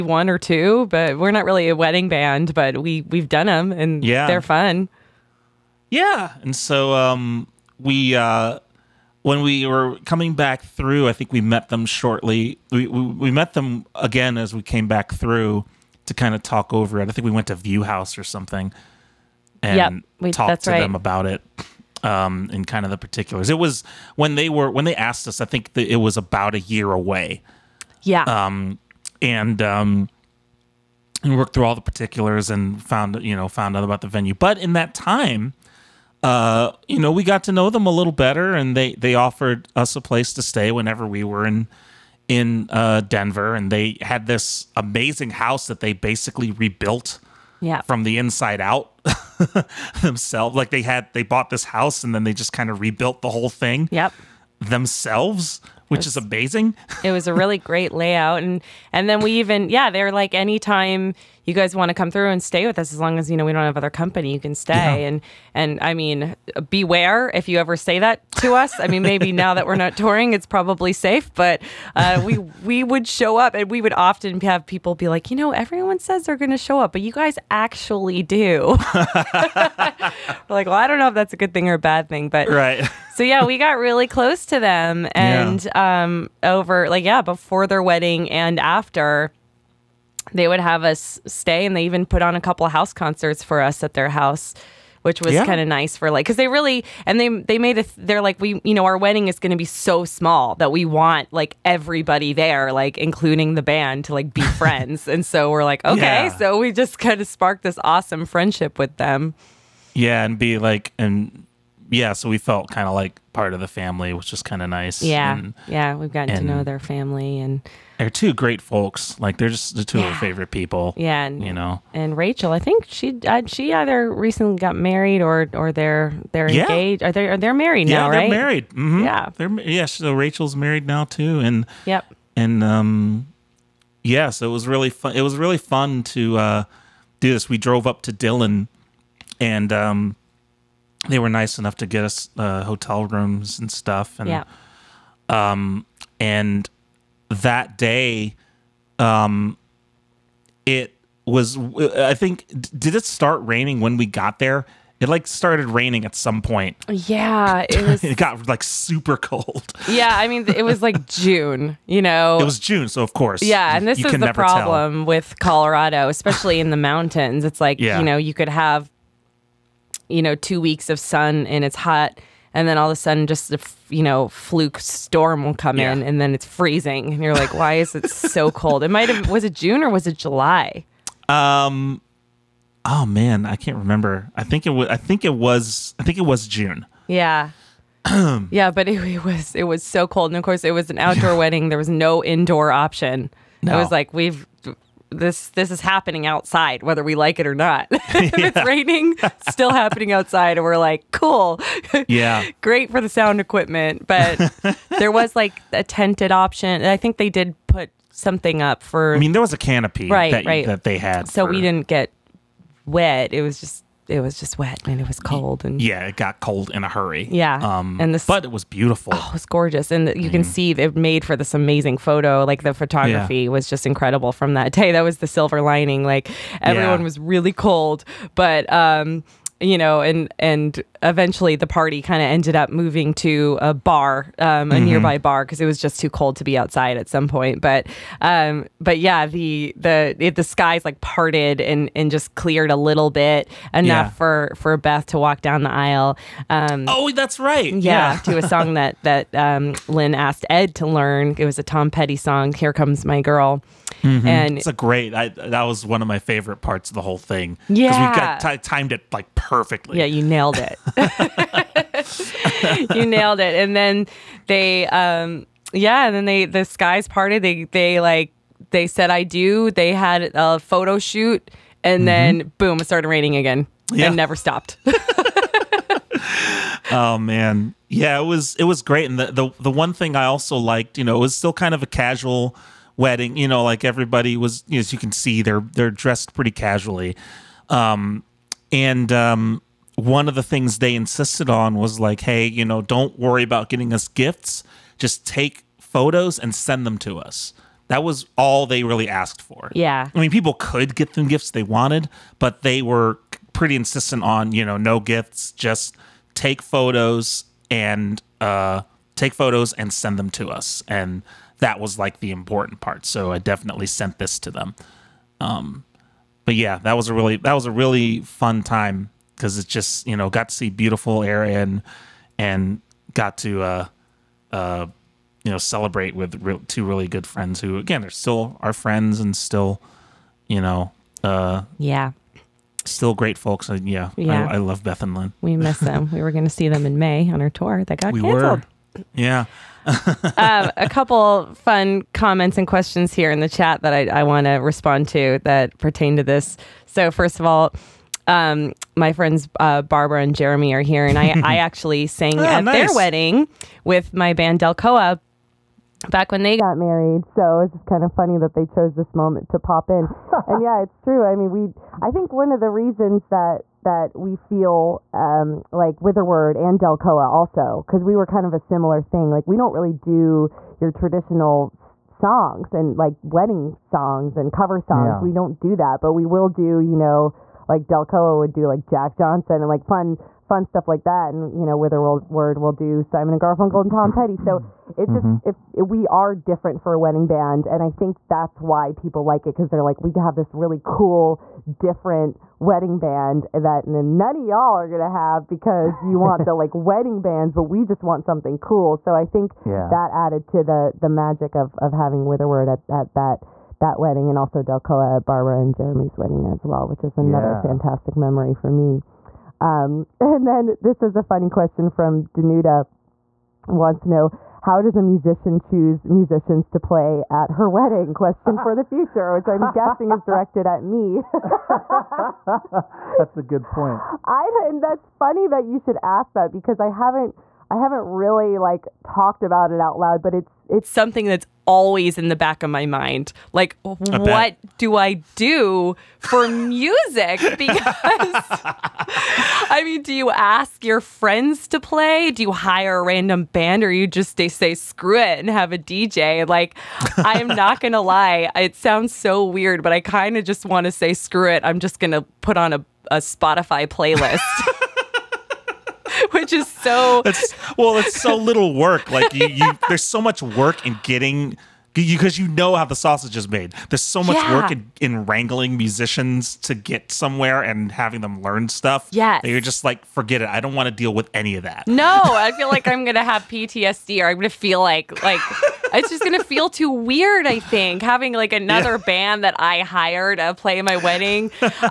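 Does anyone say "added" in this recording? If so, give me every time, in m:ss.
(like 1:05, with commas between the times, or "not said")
6:40.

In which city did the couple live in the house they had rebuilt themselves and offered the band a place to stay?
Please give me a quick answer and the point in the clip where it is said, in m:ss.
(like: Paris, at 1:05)
Denver, at 0:42.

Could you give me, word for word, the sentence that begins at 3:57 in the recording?
But um, but yeah, the the it, the skies like parted and and just cleared a little bit enough yeah.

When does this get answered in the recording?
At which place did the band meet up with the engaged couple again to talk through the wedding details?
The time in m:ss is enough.
0:17.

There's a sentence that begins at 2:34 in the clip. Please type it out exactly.
It like started raining at some point.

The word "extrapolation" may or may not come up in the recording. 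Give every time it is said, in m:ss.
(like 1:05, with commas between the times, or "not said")
not said.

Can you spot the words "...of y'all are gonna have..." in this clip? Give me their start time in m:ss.
6:34.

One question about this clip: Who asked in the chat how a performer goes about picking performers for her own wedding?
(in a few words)
Danuta.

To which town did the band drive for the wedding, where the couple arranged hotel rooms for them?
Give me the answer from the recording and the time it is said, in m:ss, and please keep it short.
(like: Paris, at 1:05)
Dillon, at 2:18.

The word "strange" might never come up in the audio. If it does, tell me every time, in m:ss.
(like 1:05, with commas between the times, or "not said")
not said.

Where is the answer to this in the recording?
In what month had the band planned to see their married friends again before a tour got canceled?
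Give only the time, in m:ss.
5:36.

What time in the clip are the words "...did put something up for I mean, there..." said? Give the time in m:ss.
3:27.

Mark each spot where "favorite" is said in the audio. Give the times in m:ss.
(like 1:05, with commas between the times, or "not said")
2:00, 4:16.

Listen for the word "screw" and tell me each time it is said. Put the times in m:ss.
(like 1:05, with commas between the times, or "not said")
7:24, 7:31.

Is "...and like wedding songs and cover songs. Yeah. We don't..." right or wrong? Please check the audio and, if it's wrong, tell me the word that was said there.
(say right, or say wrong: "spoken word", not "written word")
right.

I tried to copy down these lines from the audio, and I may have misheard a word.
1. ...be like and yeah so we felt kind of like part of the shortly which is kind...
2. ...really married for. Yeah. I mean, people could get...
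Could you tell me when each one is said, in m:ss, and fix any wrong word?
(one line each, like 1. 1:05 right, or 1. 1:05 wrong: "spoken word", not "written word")
1. 1:50 wrong: "family", not "shortly"
2. 4:58 wrong: "asked", not "married".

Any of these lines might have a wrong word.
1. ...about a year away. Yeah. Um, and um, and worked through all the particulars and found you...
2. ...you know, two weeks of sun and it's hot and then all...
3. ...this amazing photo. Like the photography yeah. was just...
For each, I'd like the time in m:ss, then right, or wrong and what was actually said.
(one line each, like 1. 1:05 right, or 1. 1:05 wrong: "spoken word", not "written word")
1. 0:26 right
2. 2:50 right
3. 3:41 right.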